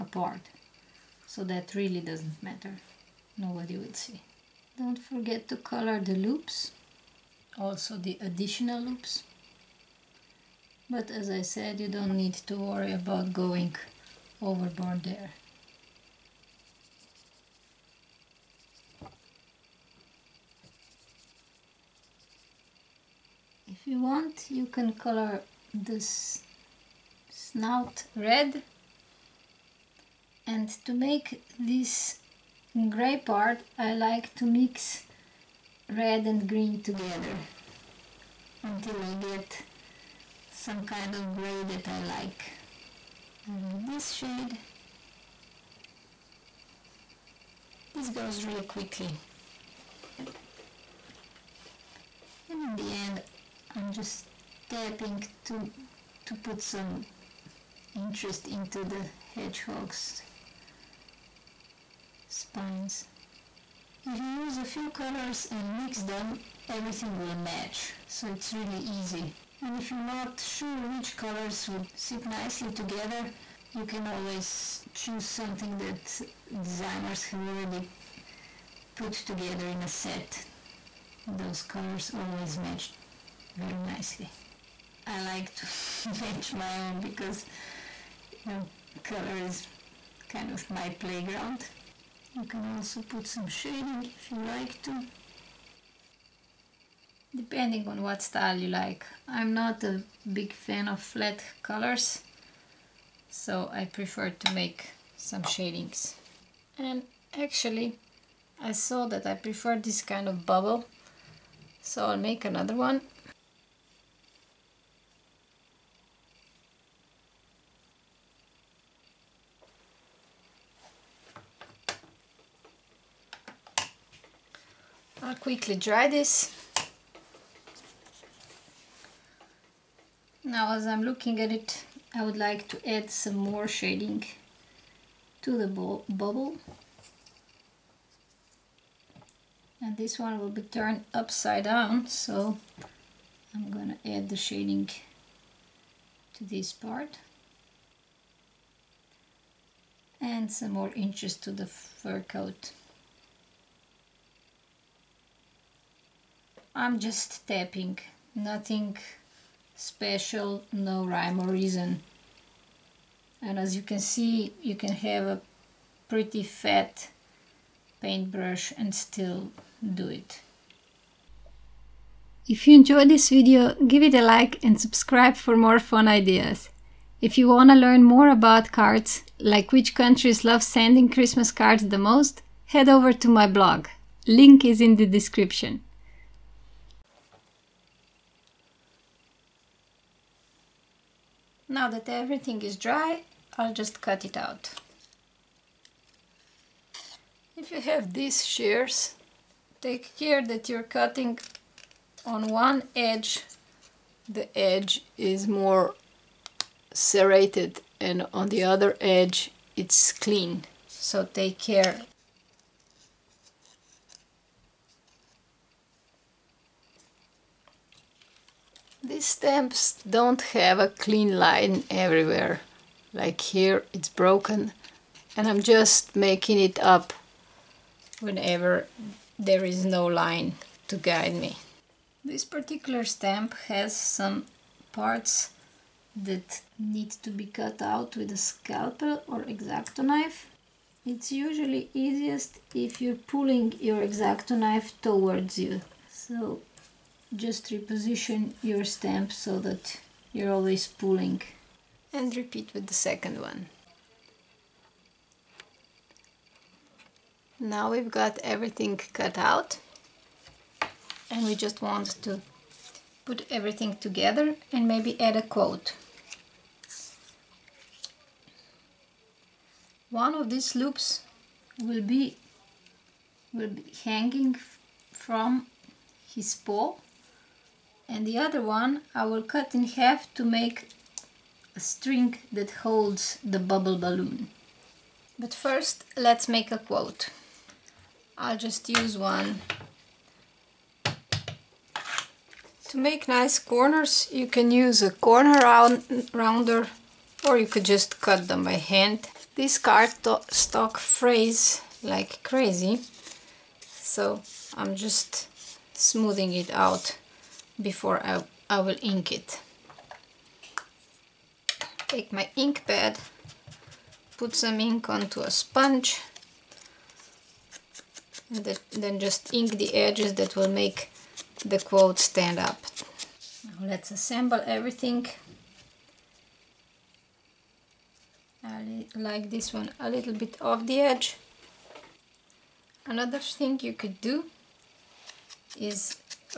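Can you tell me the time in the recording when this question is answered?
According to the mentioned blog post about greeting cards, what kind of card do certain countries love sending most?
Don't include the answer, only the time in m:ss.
3:01.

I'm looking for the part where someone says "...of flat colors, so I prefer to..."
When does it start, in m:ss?
1:40.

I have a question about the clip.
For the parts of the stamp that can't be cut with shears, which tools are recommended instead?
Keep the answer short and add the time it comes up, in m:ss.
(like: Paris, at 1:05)
Scalpel or exacto knife, at 3:58.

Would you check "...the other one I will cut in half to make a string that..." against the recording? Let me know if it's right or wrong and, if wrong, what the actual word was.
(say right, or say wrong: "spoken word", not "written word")
right.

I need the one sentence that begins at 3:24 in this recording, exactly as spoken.
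The edge is more serrated and on the other edge it's clean.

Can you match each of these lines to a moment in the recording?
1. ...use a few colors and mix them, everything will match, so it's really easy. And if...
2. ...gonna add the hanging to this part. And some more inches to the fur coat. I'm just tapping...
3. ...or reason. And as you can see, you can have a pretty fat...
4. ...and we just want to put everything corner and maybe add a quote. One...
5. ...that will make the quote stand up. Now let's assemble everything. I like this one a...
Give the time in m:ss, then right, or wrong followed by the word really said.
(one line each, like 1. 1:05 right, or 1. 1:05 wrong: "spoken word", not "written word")
1. 1:04 right
2. 2:23 wrong: "shading", not "hanging"
3. 2:41 right
4. 4:21 wrong: "together", not "corner"
5. 5:20 right.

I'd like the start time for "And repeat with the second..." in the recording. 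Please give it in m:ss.
4:12.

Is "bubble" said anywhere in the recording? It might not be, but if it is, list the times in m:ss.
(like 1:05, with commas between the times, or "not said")
1:50, 2:15, 4:43.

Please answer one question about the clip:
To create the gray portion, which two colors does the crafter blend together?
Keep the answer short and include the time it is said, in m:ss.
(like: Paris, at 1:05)
Red and green, at 0:35.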